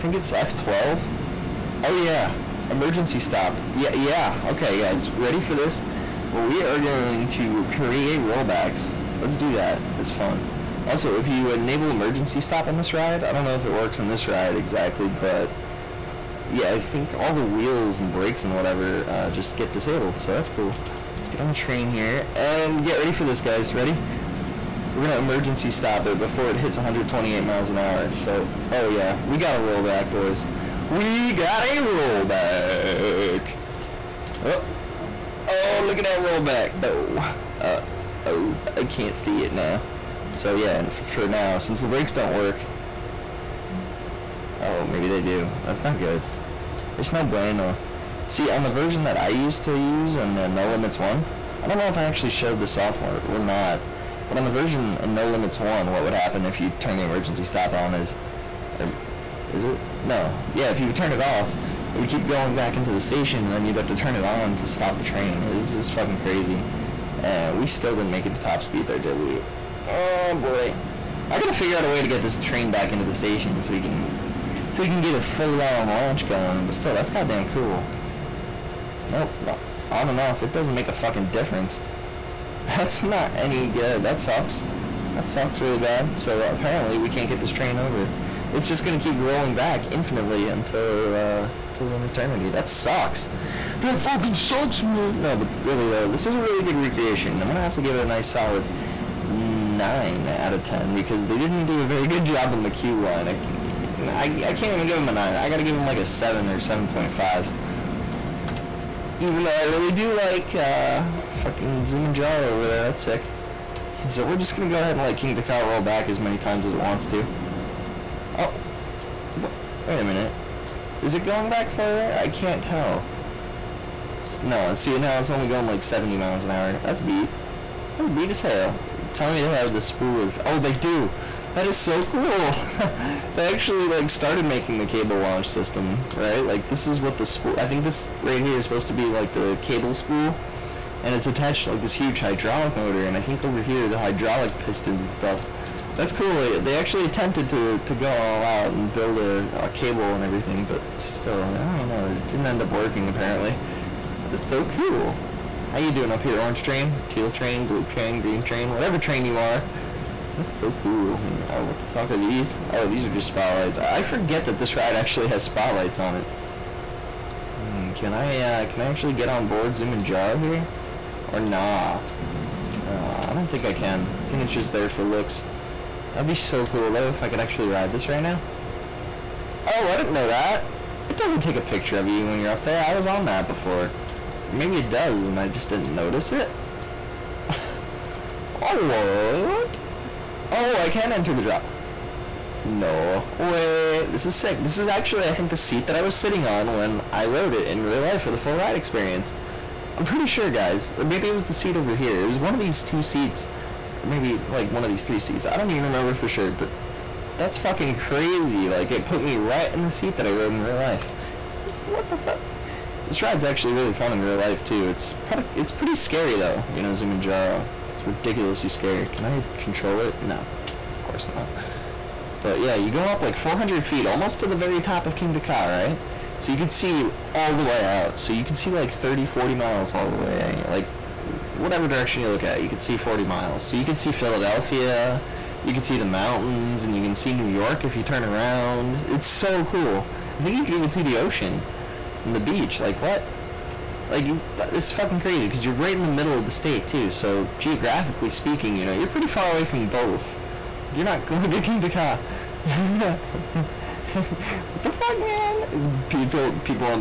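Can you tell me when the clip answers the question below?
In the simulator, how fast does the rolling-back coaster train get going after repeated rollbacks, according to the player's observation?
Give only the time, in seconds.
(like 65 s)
125 s.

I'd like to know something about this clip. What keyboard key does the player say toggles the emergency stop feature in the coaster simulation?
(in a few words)
F12.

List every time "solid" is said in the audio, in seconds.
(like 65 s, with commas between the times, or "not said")
98 s.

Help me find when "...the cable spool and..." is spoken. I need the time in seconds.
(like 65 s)
139 s.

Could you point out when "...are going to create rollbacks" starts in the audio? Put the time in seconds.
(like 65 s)
6 s.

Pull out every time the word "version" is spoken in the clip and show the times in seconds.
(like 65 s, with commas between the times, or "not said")
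48 s, 54 s.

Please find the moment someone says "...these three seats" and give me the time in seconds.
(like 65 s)
204 s.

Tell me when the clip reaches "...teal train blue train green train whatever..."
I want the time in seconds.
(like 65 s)
157 s.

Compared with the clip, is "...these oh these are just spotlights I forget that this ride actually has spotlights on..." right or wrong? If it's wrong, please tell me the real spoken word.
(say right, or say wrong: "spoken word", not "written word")
right.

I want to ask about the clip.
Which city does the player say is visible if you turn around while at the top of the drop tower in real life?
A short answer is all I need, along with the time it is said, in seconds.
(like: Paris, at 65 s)
New York, at 237 s.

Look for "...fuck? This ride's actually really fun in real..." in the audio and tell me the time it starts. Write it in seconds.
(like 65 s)
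212 s.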